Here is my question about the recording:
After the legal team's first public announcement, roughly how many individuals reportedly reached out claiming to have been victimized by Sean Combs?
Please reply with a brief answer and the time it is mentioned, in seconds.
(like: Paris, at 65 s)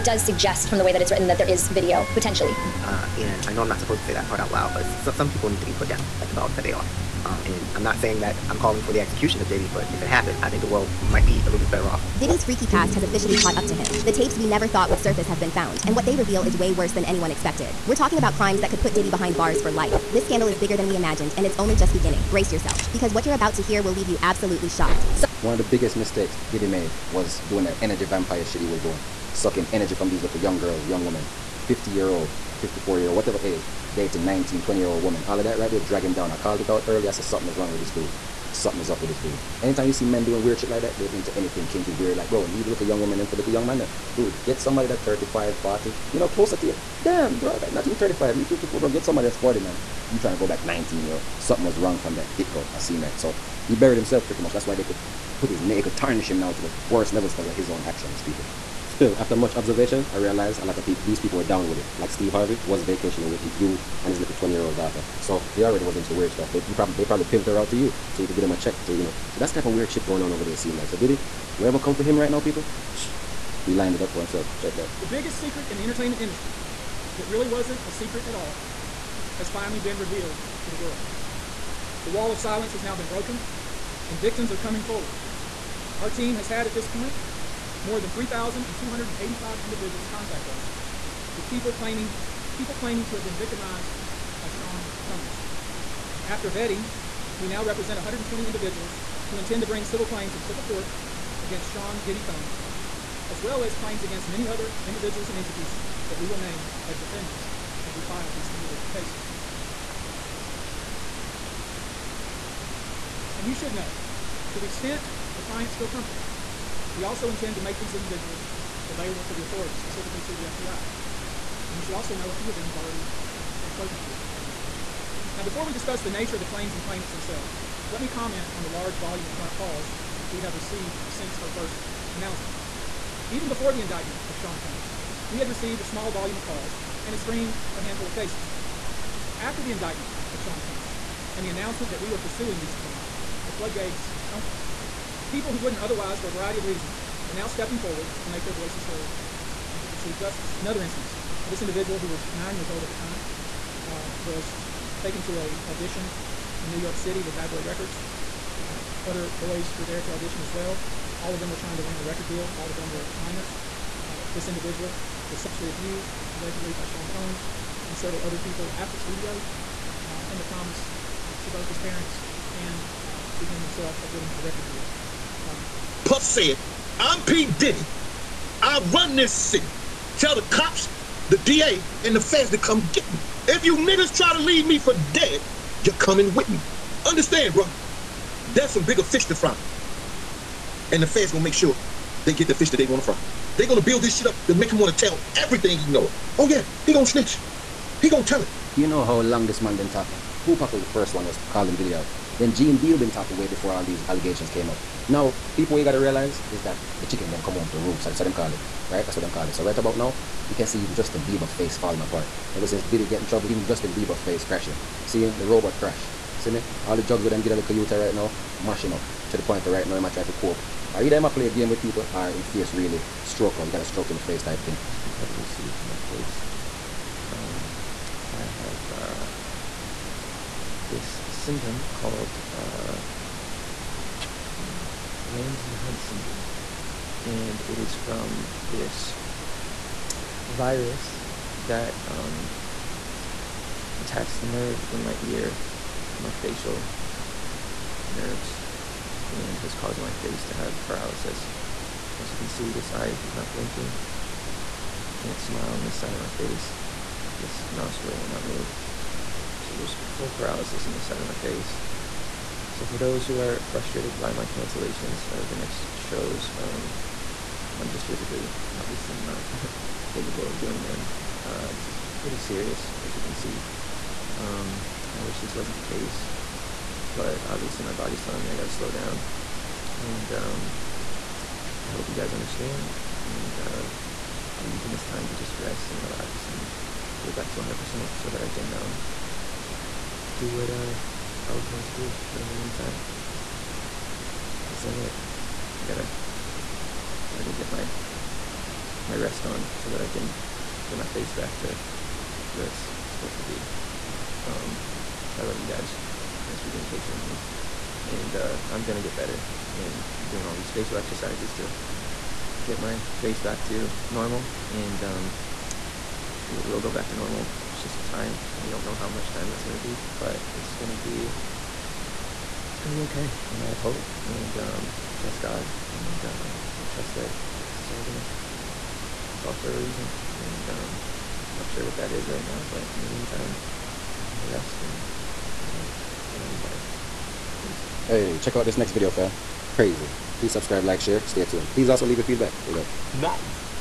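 3,285, at 88 s.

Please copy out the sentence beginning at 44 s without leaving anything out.
Dude, get somebody that's 35, 40, you know, closer to you.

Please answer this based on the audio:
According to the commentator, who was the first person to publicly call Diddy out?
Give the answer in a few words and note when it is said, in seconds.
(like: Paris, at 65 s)
Tupac, at 200 s.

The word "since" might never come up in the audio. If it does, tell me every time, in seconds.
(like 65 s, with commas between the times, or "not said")
131 s, 212 s.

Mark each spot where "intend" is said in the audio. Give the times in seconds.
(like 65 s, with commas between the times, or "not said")
99 s, 117 s.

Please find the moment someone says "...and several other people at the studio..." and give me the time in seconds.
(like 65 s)
167 s.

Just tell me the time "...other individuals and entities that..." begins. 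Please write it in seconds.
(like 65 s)
104 s.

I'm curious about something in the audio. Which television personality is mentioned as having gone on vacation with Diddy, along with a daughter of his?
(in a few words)
Steve Harvey.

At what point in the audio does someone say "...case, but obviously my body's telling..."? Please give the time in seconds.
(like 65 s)
275 s.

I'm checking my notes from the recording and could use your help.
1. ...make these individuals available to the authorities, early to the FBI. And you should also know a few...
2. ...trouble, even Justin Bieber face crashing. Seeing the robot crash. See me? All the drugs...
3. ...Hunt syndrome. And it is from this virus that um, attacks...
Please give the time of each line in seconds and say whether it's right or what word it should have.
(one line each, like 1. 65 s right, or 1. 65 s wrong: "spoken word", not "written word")
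1. 117 s wrong: "specifically", not "early"
2. 213 s right
3. 235 s right.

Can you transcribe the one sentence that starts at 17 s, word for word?
We're talking about crimes that could put Diddy behind bars for life.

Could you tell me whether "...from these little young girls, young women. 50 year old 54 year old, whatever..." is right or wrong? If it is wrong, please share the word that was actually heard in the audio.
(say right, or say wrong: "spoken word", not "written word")
right.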